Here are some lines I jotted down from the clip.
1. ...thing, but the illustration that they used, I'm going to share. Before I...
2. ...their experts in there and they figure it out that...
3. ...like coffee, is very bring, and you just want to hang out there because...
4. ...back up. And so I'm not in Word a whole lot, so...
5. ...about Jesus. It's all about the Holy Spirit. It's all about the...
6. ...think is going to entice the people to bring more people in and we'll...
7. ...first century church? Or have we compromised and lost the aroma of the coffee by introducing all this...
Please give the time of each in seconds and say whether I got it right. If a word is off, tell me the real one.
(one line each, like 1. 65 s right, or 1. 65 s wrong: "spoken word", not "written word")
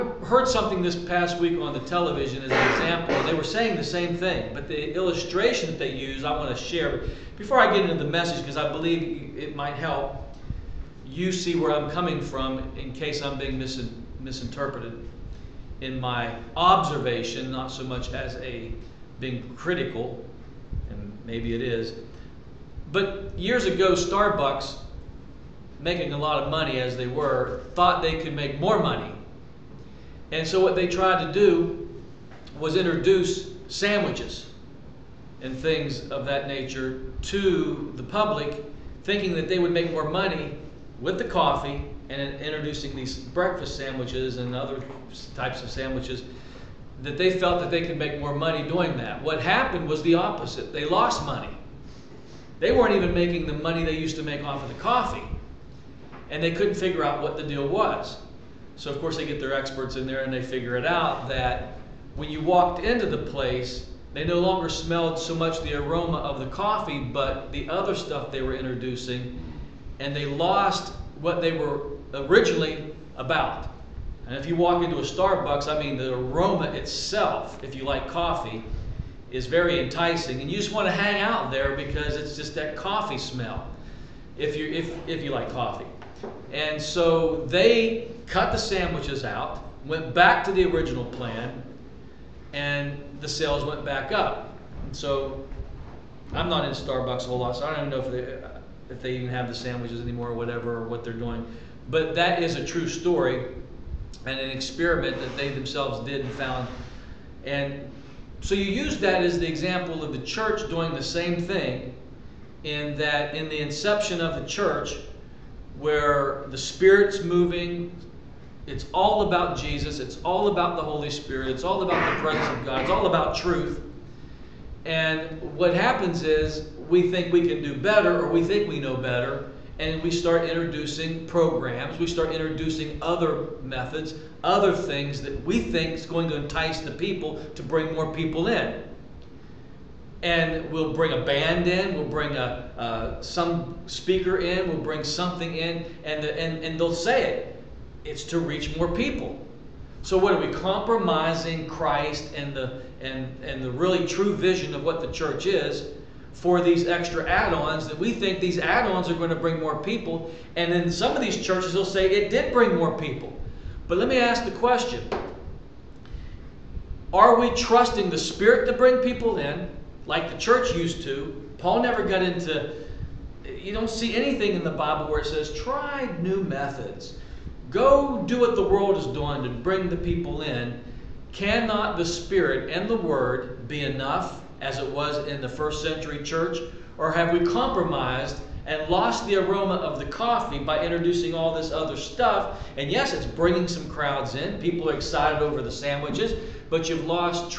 1. 4 s right
2. 59 s right
3. 77 s wrong: "enticing", not "bring"
4. 93 s wrong: "Starbucks", not "Word"
5. 119 s right
6. 135 s right
7. 185 s right.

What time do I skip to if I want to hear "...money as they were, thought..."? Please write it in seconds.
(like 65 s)
26 s.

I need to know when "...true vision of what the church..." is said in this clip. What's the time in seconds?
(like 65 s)
154 s.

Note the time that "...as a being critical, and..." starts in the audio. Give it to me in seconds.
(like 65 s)
18 s.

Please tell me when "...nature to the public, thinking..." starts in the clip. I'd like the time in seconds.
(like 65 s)
36 s.